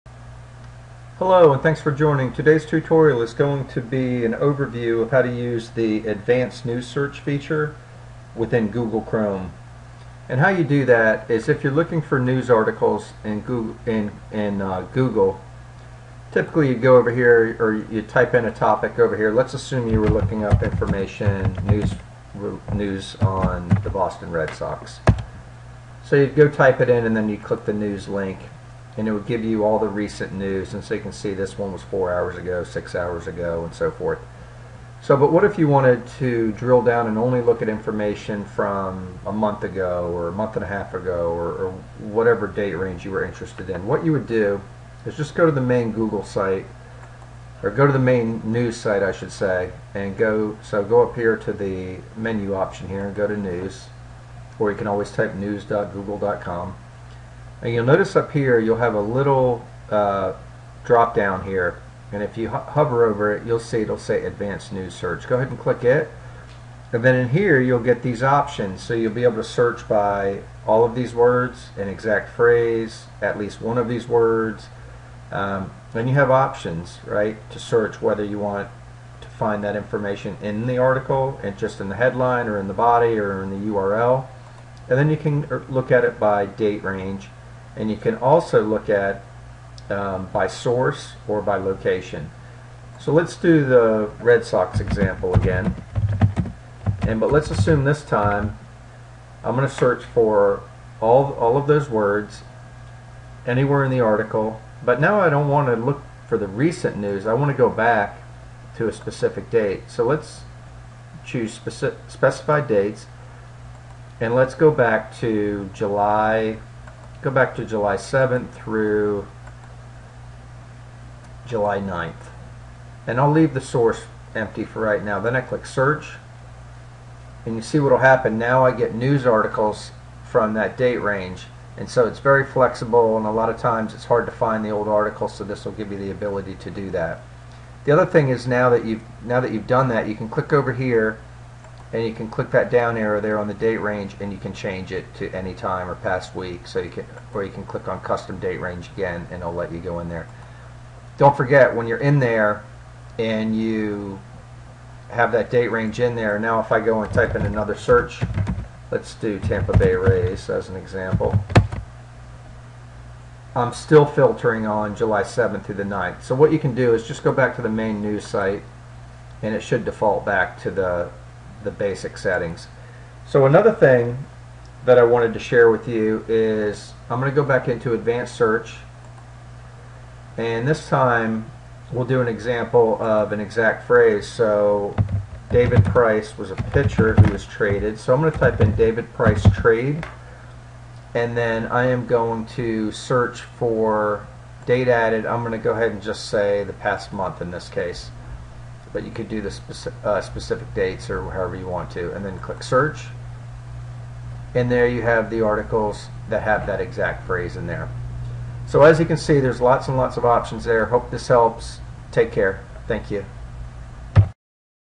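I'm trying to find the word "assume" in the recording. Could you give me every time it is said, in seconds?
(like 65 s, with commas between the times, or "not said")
19 s, 97 s.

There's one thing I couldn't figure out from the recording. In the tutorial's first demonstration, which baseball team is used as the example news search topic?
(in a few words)
Boston Red Sox.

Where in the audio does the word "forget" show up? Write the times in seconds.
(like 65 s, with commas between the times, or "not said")
151 s.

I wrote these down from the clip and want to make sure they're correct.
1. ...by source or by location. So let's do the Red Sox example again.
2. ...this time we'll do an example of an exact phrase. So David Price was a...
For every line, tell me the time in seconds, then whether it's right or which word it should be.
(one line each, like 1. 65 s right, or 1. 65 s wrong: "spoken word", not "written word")
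1. 90 s right
2. 180 s right.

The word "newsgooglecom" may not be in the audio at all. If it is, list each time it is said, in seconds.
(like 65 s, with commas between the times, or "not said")
55 s.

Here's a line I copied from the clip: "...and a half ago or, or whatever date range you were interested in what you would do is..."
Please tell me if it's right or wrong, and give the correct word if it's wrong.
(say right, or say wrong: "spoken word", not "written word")
right.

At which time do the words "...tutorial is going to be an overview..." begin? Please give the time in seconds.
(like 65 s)
2 s.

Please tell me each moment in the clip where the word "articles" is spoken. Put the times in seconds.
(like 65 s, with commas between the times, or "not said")
12 s, 80 s, 104 s, 129 s, 134 s, 205 s.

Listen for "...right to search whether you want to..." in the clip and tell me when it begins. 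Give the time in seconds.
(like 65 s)
77 s.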